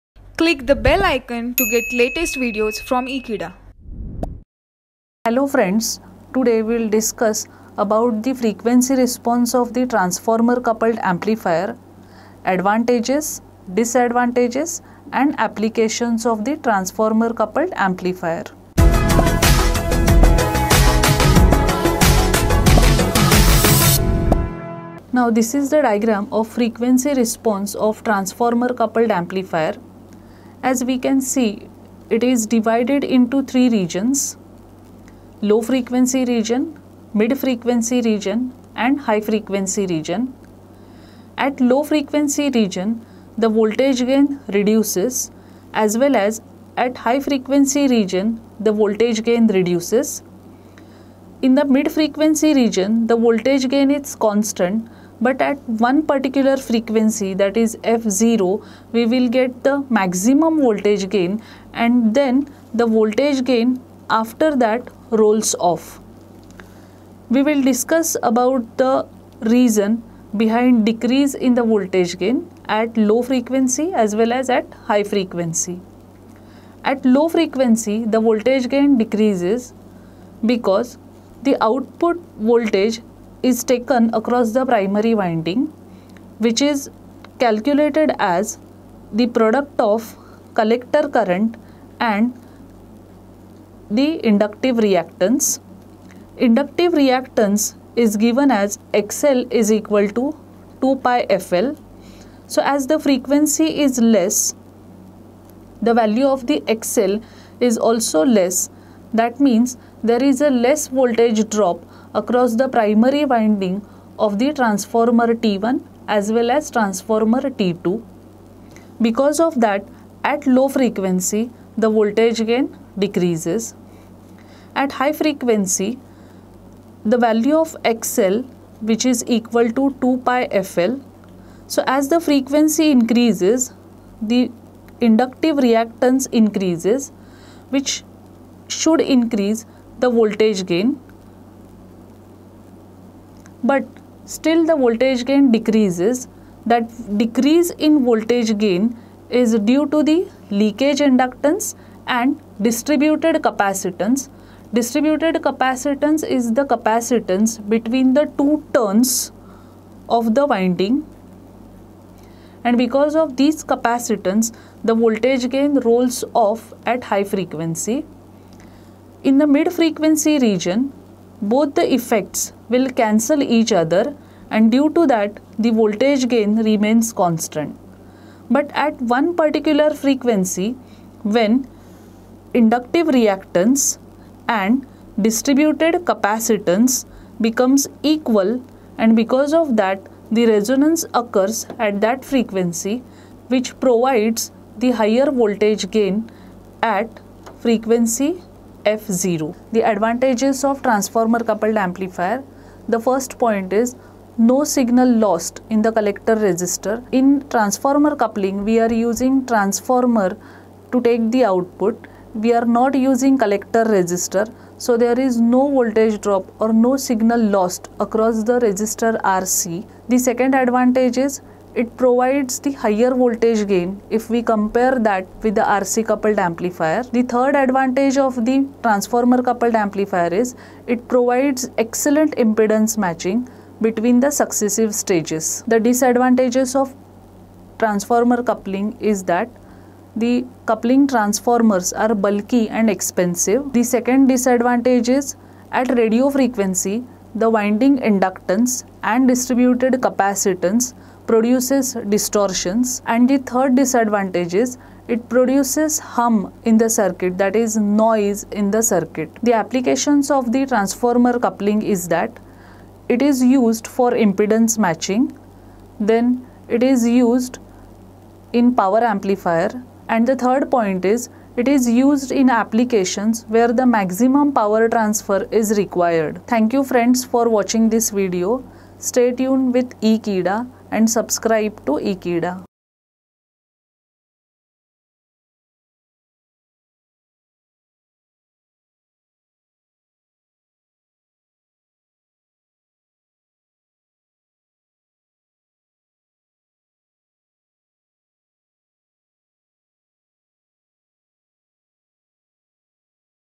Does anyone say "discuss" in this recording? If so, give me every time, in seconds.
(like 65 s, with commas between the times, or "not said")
6 s, 67 s.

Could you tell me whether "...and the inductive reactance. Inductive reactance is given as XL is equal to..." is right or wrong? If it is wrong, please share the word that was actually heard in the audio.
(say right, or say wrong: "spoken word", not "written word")
right.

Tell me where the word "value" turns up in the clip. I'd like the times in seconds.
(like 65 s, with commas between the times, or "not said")
105 s, 127 s.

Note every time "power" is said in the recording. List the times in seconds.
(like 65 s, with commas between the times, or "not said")
268 s, 274 s.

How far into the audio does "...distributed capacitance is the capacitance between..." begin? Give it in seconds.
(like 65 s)
154 s.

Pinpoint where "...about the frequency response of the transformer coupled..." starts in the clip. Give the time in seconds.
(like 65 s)
7 s.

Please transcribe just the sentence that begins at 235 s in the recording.
The disadvantages of transformer coupling is that the coupling transformers are bulky and expensive.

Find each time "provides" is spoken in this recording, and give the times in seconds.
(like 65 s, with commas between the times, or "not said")
193 s, 221 s, 231 s.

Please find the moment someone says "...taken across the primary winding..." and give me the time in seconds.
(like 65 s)
83 s.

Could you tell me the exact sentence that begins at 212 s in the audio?
We are not using collector resistor.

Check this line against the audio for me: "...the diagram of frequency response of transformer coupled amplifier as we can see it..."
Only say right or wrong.
right.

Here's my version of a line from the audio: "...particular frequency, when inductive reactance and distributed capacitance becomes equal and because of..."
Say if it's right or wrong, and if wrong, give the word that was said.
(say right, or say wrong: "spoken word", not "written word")
right.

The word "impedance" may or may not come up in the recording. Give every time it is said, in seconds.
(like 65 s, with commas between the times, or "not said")
232 s, 264 s.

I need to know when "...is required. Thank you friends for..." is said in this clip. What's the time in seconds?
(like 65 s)
275 s.